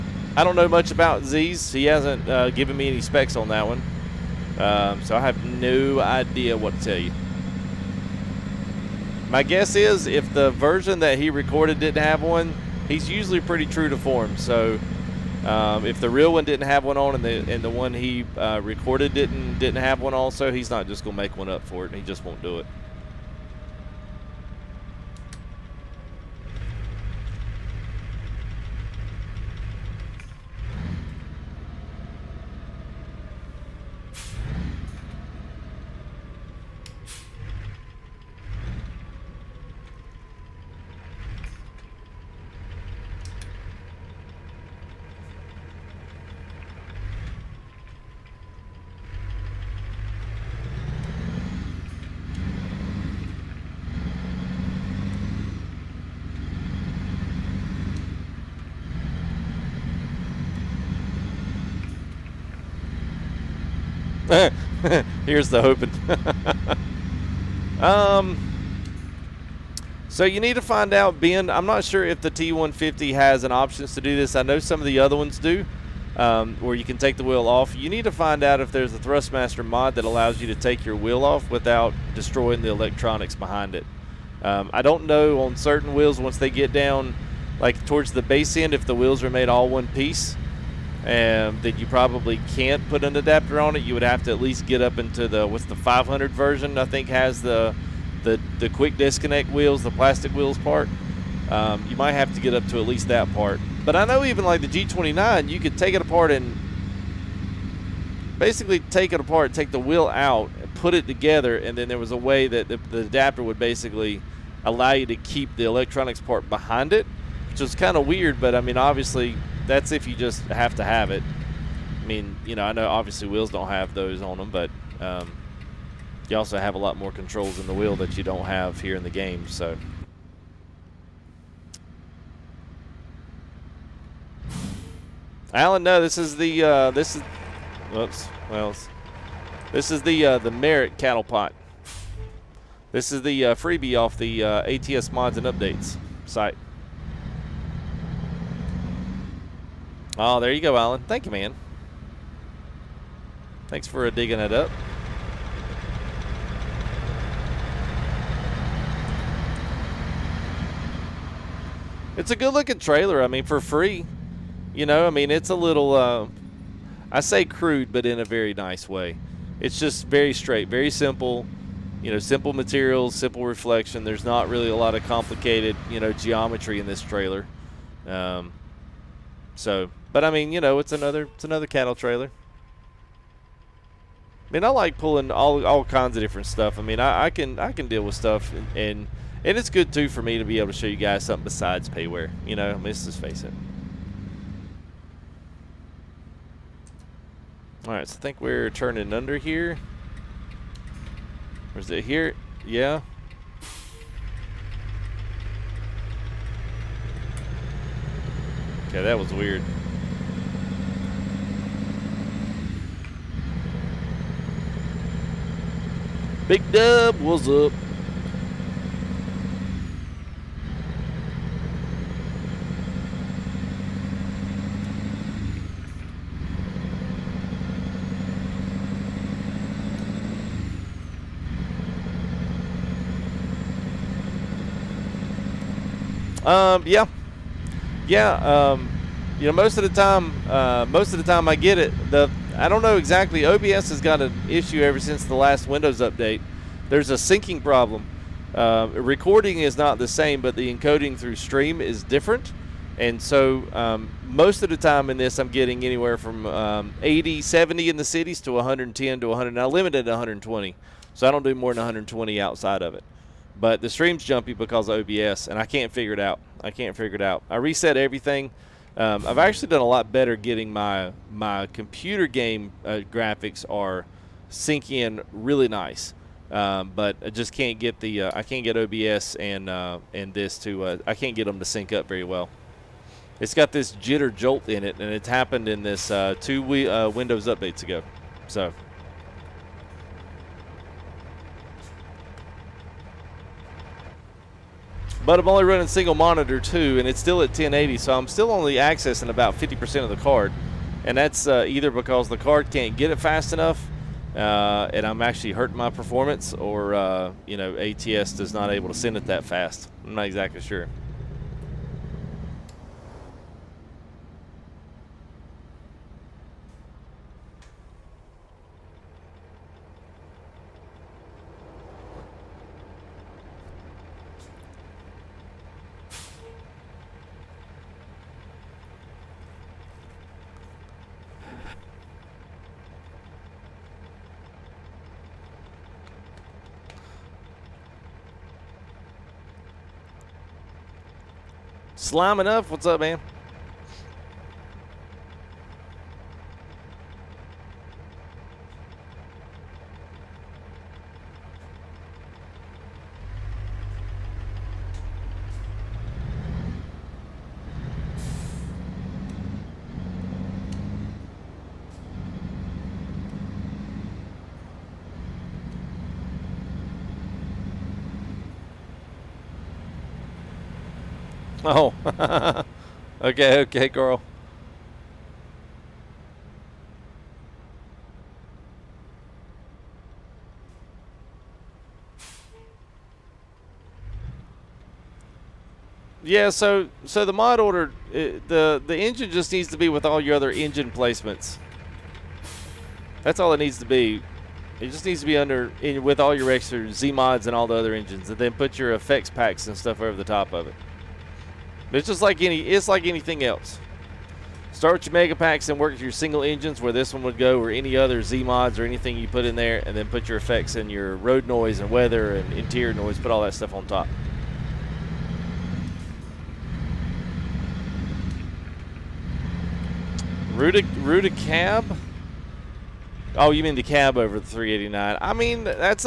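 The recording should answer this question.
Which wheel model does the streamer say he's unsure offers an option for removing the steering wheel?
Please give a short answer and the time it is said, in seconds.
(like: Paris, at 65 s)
T150, at 72 s.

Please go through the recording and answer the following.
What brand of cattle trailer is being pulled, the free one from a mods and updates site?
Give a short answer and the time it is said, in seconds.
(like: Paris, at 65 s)
Merit, at 140 s.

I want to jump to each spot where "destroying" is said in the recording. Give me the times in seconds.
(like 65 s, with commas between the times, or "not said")
82 s.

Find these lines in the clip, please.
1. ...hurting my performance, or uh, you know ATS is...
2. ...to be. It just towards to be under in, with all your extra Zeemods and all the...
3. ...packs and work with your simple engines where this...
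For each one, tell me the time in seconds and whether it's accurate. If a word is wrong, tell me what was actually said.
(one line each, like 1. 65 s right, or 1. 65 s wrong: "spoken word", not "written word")
1. 305 s right
2. 393 s wrong: "needs", not "towards"
3. 405 s wrong: "single", not "simple".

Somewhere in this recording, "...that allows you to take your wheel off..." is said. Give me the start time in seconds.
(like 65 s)
79 s.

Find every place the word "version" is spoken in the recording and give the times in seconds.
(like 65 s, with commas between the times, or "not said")
10 s, 96 s.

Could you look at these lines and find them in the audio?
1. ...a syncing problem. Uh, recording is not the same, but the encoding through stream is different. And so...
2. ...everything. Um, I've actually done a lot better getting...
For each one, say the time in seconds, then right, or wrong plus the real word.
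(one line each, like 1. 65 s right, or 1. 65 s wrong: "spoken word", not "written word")
1. 247 s right
2. 267 s right.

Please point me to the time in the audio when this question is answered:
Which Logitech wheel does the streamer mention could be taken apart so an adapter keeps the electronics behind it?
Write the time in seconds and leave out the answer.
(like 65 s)
104 s.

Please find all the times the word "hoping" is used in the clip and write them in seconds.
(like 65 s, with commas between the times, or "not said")
67 s.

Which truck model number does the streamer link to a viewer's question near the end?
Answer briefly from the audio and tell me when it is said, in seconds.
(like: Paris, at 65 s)
389, at 424 s.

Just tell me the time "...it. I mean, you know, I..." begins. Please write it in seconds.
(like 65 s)
121 s.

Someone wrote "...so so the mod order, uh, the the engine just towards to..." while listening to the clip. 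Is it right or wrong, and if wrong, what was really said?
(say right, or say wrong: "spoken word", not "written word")
wrong: "needs", not "towards".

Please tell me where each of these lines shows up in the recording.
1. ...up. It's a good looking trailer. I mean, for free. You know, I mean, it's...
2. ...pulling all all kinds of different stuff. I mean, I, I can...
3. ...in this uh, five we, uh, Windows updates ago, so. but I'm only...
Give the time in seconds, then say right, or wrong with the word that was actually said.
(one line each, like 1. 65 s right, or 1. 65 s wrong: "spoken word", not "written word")
1. 154 s right
2. 184 s right
3. 285 s wrong: "two", not "five".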